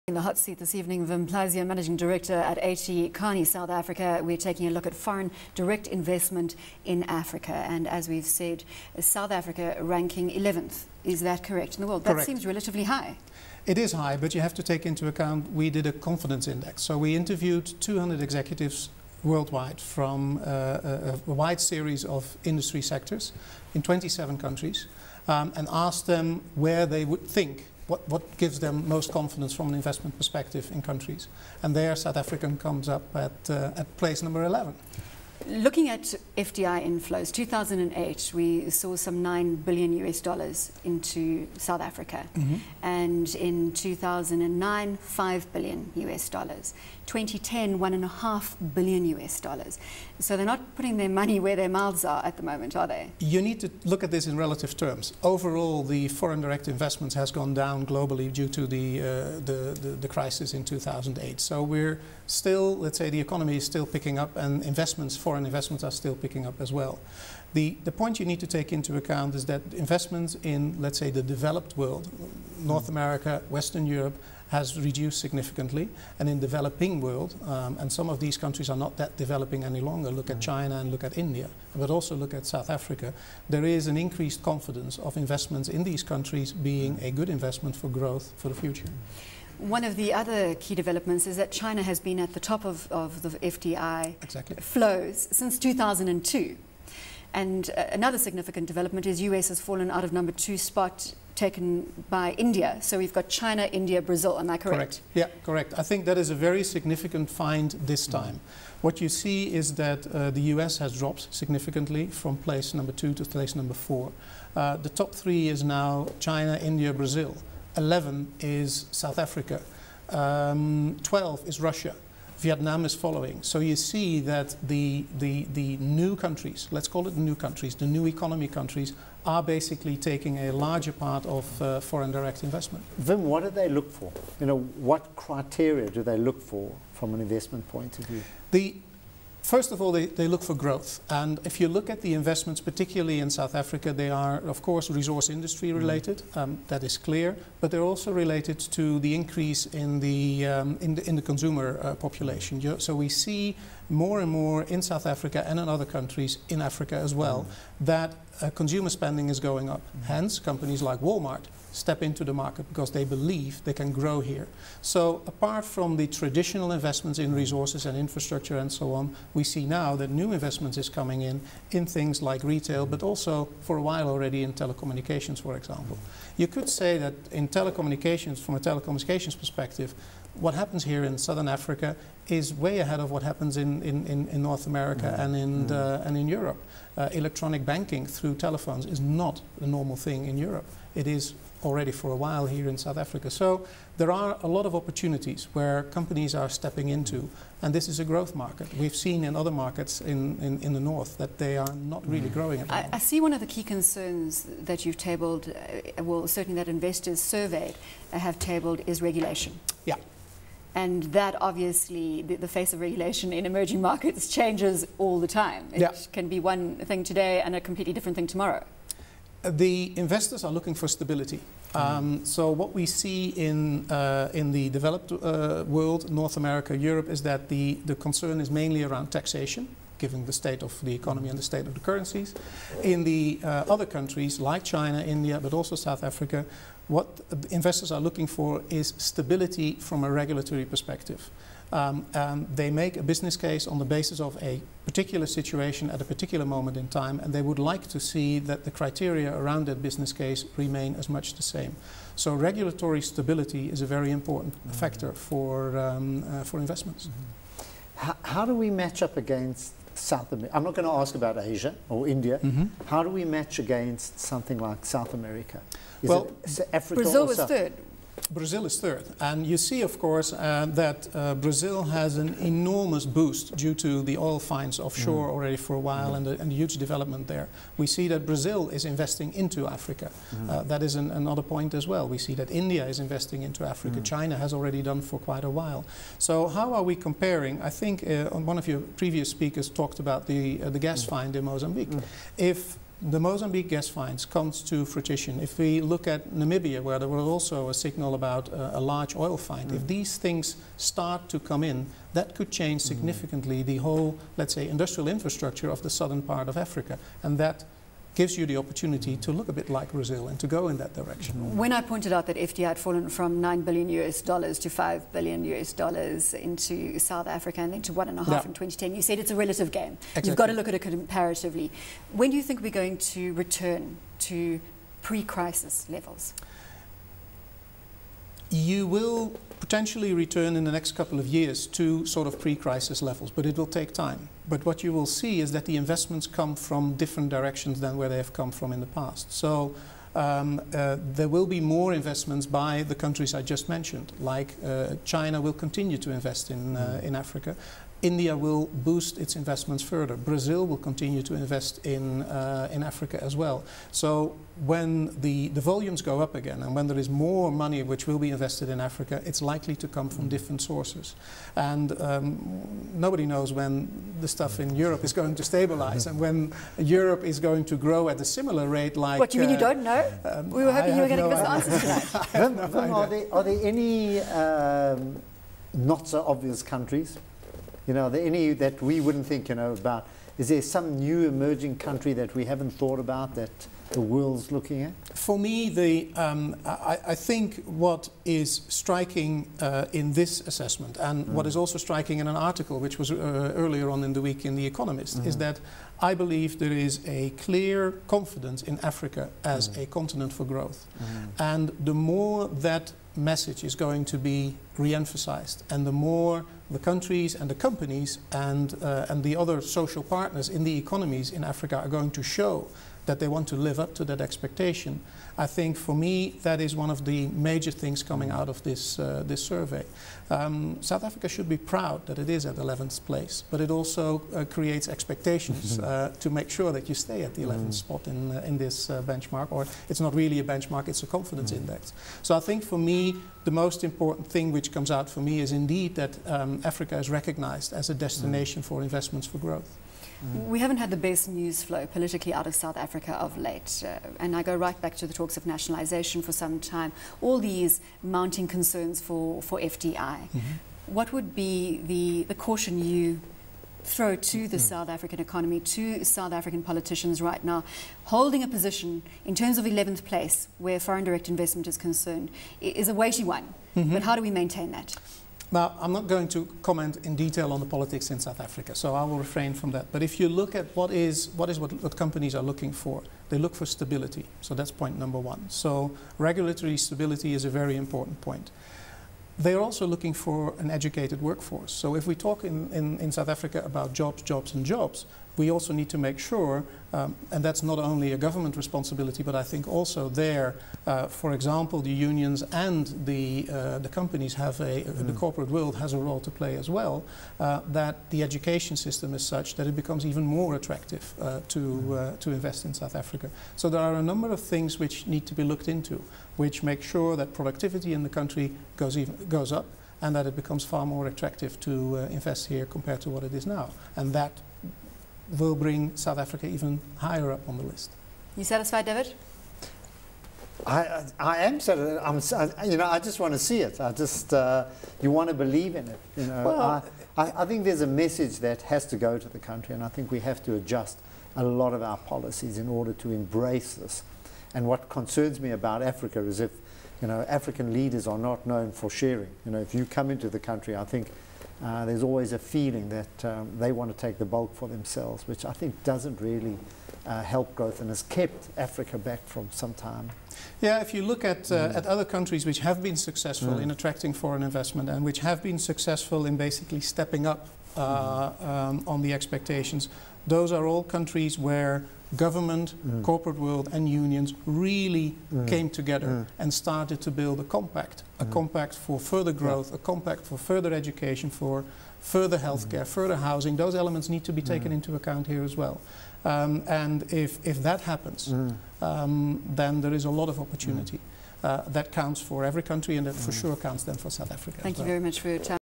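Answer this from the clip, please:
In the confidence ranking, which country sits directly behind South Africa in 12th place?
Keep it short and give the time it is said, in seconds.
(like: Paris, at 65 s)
Russia, at 121 s.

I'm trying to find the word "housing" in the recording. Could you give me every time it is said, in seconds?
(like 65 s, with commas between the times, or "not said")
573 s.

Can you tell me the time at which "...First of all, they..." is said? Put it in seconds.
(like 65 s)
139 s.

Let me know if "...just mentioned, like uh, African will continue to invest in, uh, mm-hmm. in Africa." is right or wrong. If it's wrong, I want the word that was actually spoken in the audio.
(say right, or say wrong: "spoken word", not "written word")
wrong: "China", not "African".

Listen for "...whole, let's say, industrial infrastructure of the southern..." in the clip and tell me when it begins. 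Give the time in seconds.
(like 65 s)
303 s.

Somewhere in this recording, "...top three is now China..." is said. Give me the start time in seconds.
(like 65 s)
114 s.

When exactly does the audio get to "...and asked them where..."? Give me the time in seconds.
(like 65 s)
25 s.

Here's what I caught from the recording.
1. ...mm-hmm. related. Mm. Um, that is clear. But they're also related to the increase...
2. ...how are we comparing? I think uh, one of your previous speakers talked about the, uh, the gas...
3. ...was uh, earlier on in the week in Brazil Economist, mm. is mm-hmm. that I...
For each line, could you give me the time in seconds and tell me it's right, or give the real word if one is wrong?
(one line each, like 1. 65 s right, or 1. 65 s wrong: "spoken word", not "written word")
1. 145 s right
2. 286 s right
3. 392 s wrong: "The", not "Brazil".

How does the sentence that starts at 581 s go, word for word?
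Uh, that counts for every country and that for sure counts then for South Africa.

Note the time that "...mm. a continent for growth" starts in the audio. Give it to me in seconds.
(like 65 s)
399 s.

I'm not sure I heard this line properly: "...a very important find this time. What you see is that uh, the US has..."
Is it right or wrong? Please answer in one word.
wrong.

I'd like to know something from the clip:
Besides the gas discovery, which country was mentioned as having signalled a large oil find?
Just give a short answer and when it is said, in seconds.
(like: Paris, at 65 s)
Namibia, at 296 s.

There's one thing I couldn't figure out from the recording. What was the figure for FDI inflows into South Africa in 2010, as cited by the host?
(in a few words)
1.5 billion US dollars.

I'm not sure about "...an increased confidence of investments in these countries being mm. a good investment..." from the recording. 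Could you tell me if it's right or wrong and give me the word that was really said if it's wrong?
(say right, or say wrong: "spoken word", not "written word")
right.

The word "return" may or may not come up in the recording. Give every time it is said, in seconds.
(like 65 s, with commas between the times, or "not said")
323 s, 330 s.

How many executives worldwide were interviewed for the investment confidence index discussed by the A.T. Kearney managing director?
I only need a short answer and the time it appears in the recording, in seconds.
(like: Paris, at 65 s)
200, at 17 s.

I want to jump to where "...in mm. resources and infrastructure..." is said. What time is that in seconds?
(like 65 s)
167 s.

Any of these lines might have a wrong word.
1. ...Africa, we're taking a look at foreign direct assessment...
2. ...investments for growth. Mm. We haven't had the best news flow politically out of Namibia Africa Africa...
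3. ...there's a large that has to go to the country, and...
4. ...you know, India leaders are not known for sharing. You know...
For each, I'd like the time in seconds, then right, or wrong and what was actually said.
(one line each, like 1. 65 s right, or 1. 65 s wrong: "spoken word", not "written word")
1. 3 s wrong: "investment", not "assessment"
2. 438 s wrong: "South", not "Namibia"
3. 527 s wrong: "message", not "large"
4. 537 s wrong: "African", not "India".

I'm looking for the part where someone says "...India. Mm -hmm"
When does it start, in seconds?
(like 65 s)
262 s.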